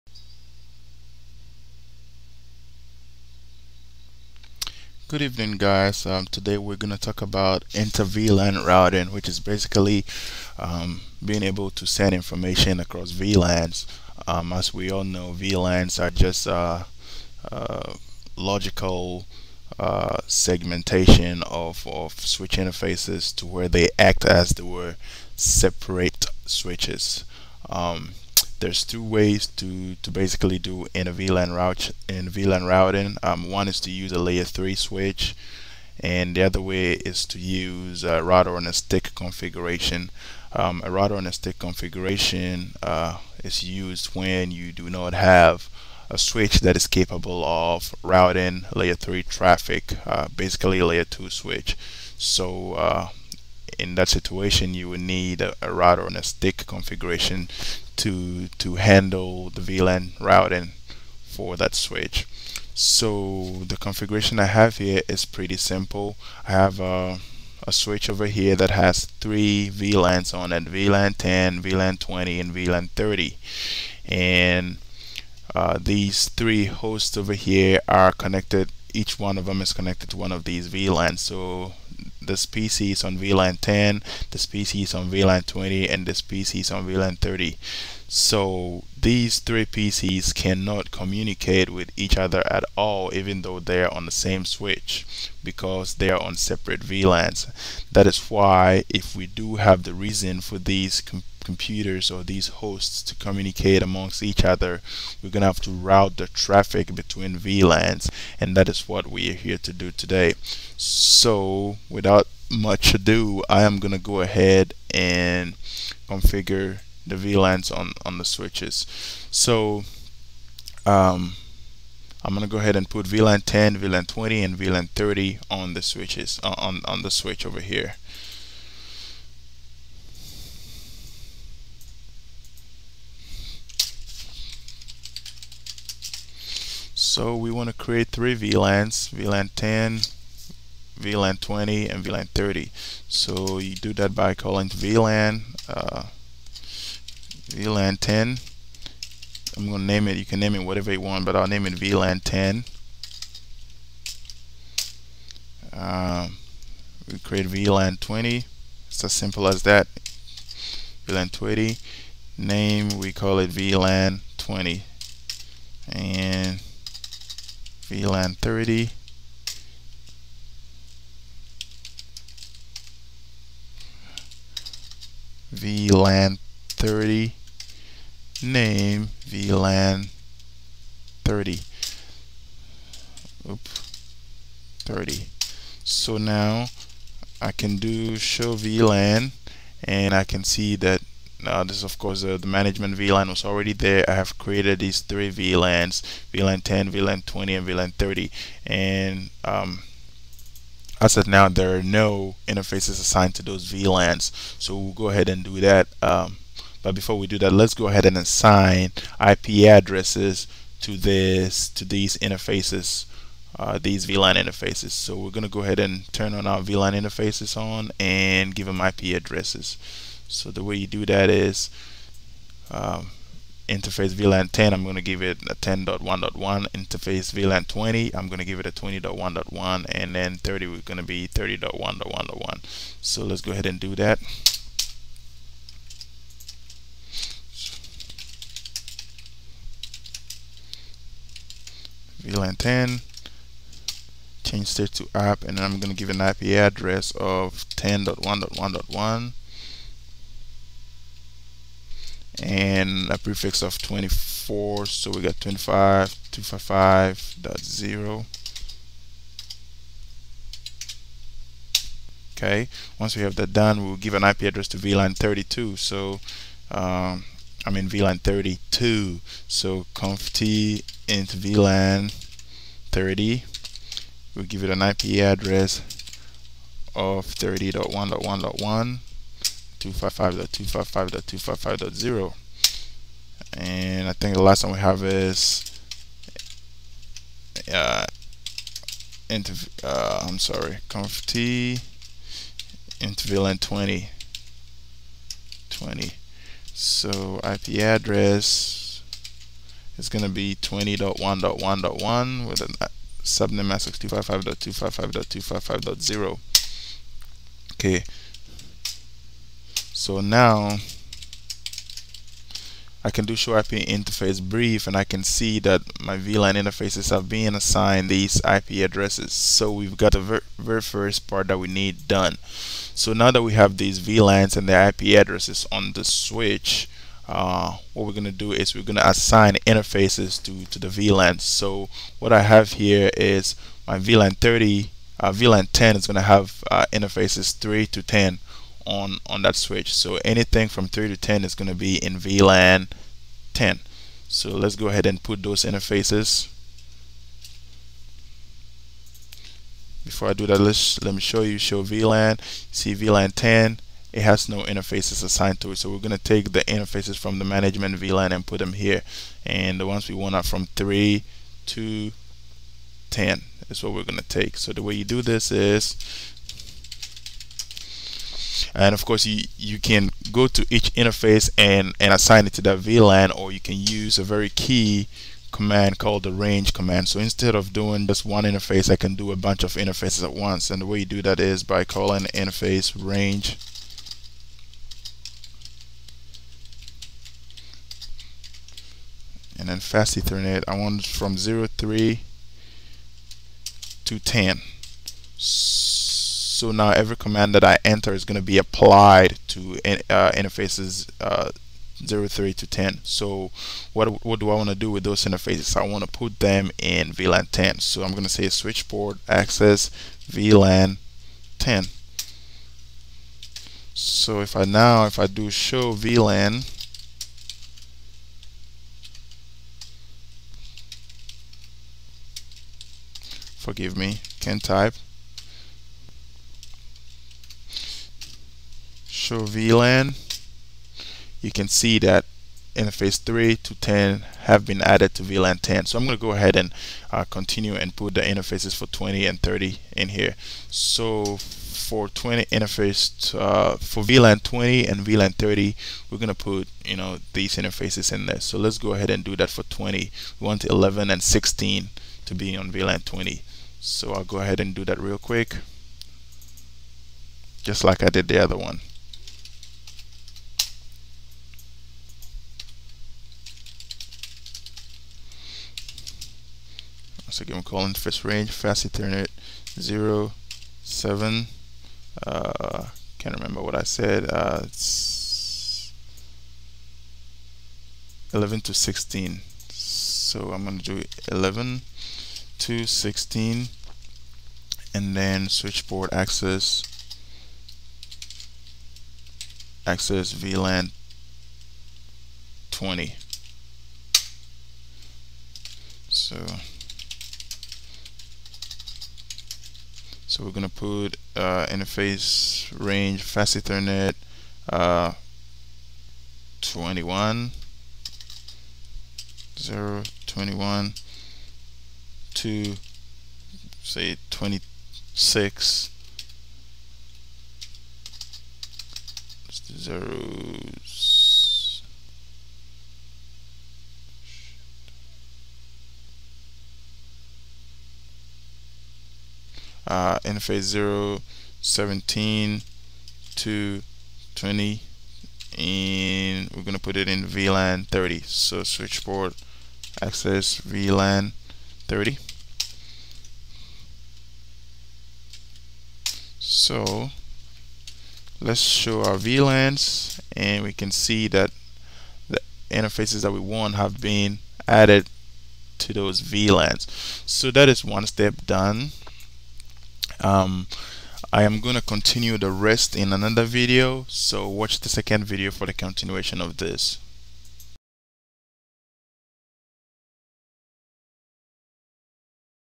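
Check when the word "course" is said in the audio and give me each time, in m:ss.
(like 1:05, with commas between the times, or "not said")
3:11, 6:09.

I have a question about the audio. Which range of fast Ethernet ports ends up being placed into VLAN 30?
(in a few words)
17 to 20.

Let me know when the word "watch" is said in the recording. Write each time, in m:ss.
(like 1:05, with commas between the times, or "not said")
9:24.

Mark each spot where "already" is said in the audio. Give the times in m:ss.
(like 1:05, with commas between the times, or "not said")
3:13.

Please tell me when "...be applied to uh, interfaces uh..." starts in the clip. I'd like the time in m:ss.
6:38.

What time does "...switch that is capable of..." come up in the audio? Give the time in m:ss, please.
0:46.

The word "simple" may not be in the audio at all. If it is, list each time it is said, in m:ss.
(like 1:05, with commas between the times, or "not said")
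1:05, 2:39.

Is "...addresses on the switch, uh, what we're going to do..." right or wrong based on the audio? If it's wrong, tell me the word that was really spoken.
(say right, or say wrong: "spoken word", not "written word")
right.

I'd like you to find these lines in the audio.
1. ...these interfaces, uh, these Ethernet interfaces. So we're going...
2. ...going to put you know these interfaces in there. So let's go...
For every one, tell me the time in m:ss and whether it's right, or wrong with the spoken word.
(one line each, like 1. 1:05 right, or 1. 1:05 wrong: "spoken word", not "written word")
1. 3:31 wrong: "VLAN", not "Ethernet"
2. 7:26 right.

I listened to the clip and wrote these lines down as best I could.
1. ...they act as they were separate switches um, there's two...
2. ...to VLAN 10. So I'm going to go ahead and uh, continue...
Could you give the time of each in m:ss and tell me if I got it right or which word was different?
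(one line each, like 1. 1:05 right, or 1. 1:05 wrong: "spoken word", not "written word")
1. 0:23 right
2. 7:15 right.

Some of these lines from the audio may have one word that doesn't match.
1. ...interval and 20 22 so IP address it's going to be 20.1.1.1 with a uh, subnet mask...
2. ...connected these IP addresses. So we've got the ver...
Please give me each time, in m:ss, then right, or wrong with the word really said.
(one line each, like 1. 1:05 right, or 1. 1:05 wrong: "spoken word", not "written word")
1. 4:52 wrong: "20", not "22"
2. 5:17 wrong: "assigned", not "connected".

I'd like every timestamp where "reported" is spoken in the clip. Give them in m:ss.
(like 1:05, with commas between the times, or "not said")
not said.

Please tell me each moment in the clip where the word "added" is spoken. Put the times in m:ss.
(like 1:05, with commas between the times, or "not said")
7:14, 9:14.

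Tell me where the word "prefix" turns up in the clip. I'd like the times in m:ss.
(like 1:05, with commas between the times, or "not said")
4:13.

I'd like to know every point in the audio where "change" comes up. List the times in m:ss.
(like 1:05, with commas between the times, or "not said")
4:04.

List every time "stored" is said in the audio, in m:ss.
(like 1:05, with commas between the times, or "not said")
not said.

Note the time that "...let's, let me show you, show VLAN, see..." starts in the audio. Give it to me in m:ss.
5:50.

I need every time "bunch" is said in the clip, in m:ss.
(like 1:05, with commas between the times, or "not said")
6:19.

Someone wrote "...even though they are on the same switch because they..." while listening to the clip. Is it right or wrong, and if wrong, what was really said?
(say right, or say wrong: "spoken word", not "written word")
right.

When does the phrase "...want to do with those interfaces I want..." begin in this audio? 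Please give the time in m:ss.
6:44.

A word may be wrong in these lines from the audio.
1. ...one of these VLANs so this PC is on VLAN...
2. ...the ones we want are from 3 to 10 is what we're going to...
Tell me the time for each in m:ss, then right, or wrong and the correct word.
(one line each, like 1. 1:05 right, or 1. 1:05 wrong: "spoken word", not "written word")
1. 1:20 right
2. 5:59 right.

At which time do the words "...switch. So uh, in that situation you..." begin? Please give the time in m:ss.
0:51.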